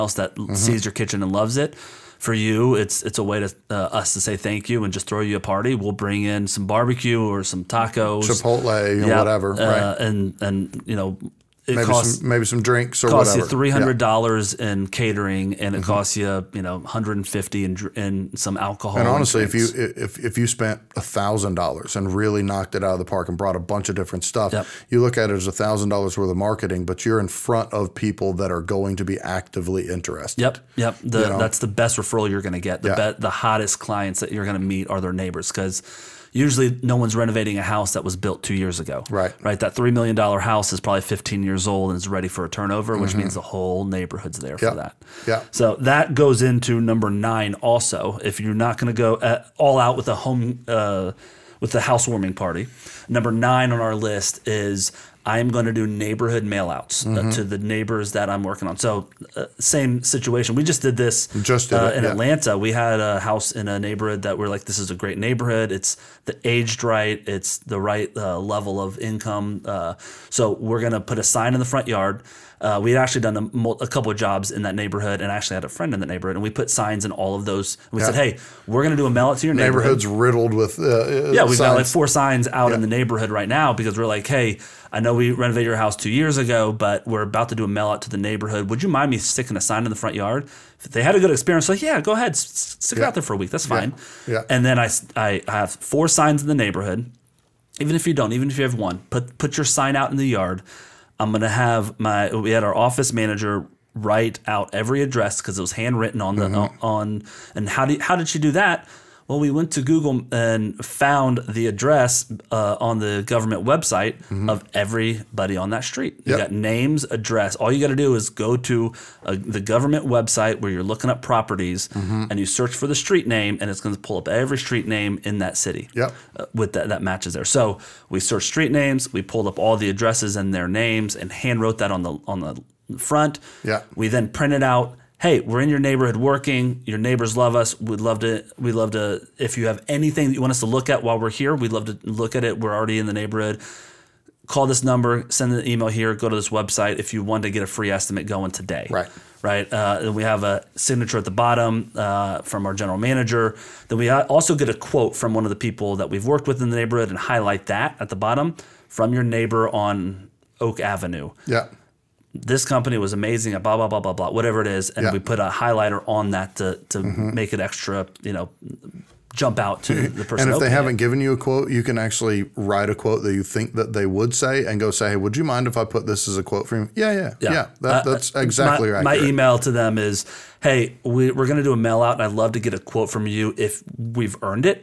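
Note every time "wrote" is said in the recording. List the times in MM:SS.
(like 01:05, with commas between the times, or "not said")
02:11.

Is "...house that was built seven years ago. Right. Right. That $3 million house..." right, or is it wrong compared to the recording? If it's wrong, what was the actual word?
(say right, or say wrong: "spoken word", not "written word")
wrong: "two", not "seven".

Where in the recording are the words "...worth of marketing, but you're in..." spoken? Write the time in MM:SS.
00:26.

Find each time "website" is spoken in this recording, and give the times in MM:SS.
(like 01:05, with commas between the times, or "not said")
01:53, 02:00, 02:26.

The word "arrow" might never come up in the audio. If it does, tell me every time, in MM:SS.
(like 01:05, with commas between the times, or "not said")
not said.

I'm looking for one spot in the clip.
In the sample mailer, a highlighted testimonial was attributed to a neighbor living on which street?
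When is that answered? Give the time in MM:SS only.
02:40.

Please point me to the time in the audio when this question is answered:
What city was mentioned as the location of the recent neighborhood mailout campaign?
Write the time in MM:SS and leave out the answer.
01:02.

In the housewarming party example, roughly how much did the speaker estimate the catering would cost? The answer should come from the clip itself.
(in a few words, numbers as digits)
$300.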